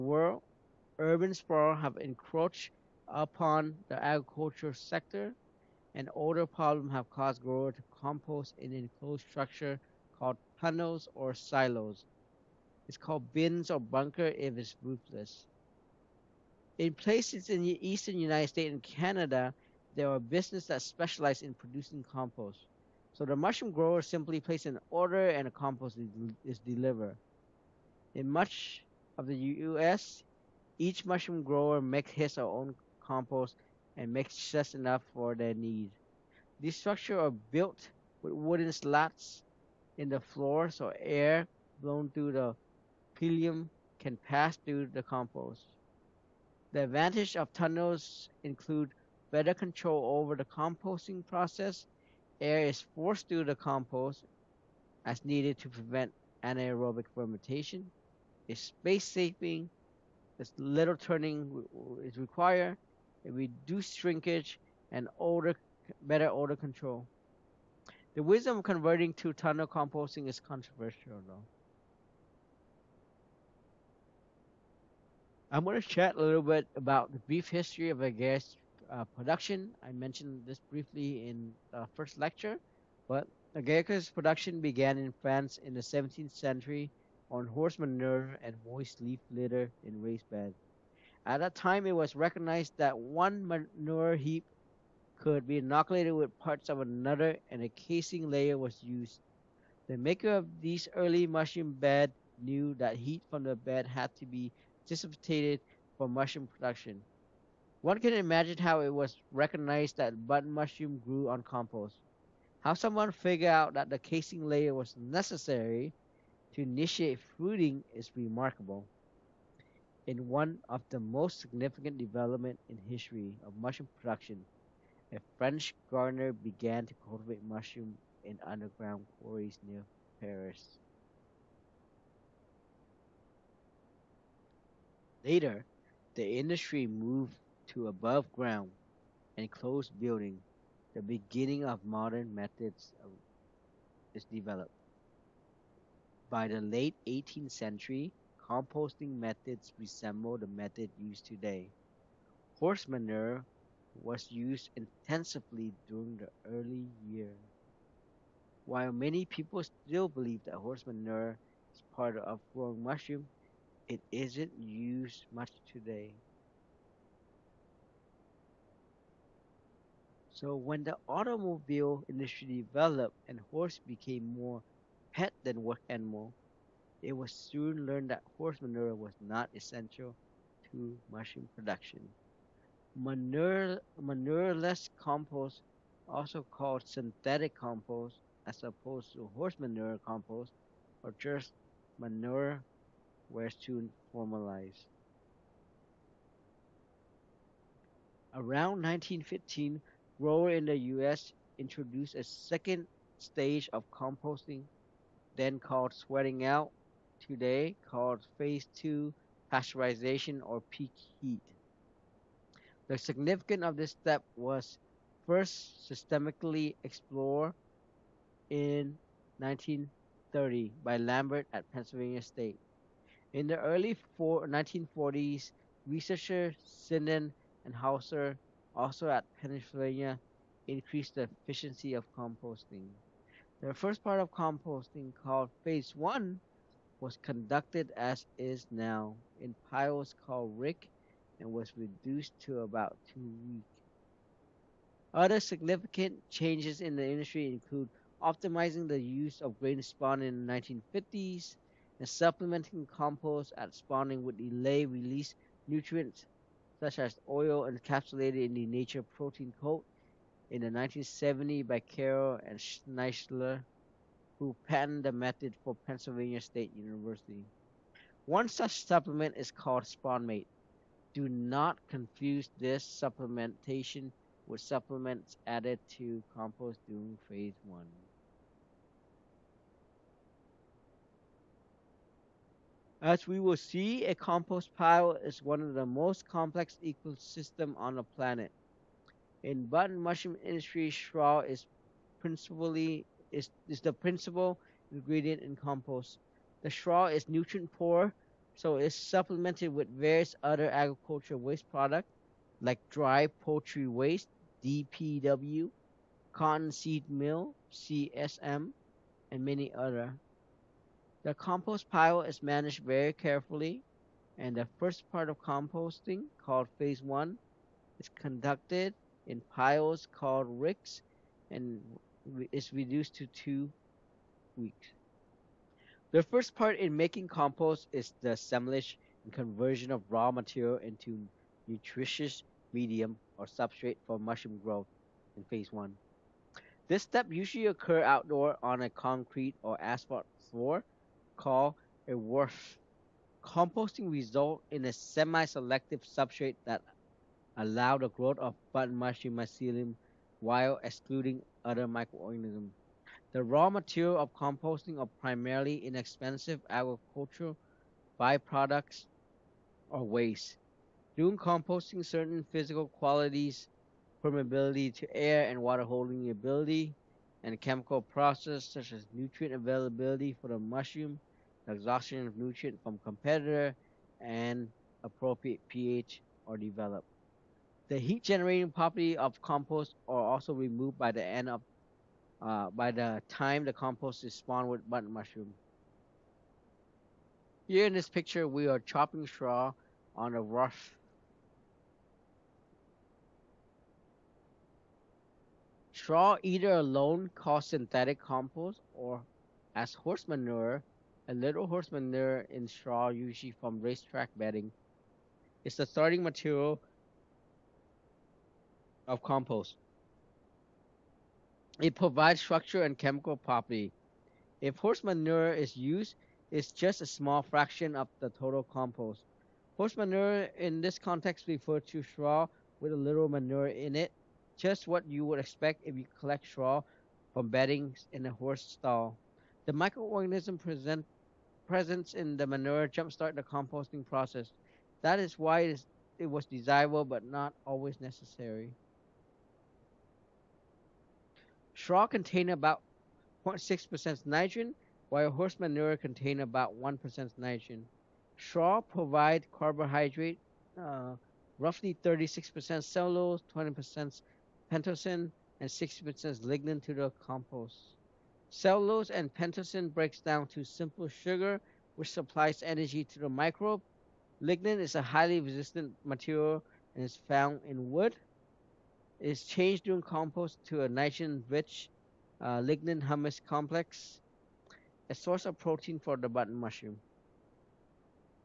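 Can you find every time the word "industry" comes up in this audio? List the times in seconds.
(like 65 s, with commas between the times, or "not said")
136 s, 172 s, 247 s, 290 s.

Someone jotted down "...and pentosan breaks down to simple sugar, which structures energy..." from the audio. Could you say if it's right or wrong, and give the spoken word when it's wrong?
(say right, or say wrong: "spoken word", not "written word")
wrong: "supplies", not "structures".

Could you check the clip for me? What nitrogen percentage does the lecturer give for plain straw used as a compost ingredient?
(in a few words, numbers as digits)
0.6%.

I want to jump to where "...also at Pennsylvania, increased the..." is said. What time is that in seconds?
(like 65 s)
228 s.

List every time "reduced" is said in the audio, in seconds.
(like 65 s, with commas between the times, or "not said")
63 s, 241 s, 322 s.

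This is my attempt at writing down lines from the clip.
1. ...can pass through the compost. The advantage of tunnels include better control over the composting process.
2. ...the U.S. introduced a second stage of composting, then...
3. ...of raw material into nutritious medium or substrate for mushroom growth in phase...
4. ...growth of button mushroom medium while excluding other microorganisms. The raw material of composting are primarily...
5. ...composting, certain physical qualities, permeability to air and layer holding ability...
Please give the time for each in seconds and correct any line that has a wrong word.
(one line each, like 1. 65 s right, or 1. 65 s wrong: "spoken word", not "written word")
1. 43 s right
2. 200 s right
3. 329 s right
4. 348 s wrong: "mycelium", not "medium"
5. 361 s wrong: "water", not "layer".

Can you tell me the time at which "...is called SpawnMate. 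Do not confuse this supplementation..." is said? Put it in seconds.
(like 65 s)
269 s.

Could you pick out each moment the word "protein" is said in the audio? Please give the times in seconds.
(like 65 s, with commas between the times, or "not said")
259 s, 475 s.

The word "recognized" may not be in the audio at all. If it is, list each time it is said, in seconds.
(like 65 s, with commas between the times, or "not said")
92 s, 109 s.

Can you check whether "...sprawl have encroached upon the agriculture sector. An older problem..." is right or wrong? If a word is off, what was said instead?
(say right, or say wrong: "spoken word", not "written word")
right.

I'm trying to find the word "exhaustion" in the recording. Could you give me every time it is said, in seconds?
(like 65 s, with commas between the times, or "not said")
371 s.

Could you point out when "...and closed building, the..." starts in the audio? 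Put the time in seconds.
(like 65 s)
139 s.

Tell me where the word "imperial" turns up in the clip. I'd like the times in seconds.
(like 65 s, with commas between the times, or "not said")
not said.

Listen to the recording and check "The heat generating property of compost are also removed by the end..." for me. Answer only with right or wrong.
right.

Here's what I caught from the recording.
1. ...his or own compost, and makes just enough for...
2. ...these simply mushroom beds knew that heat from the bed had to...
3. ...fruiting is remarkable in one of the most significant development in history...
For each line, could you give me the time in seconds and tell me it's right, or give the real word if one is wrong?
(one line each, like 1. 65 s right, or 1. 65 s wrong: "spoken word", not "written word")
1. 32 s right
2. 100 s wrong: "early", not "simply"
3. 117 s right.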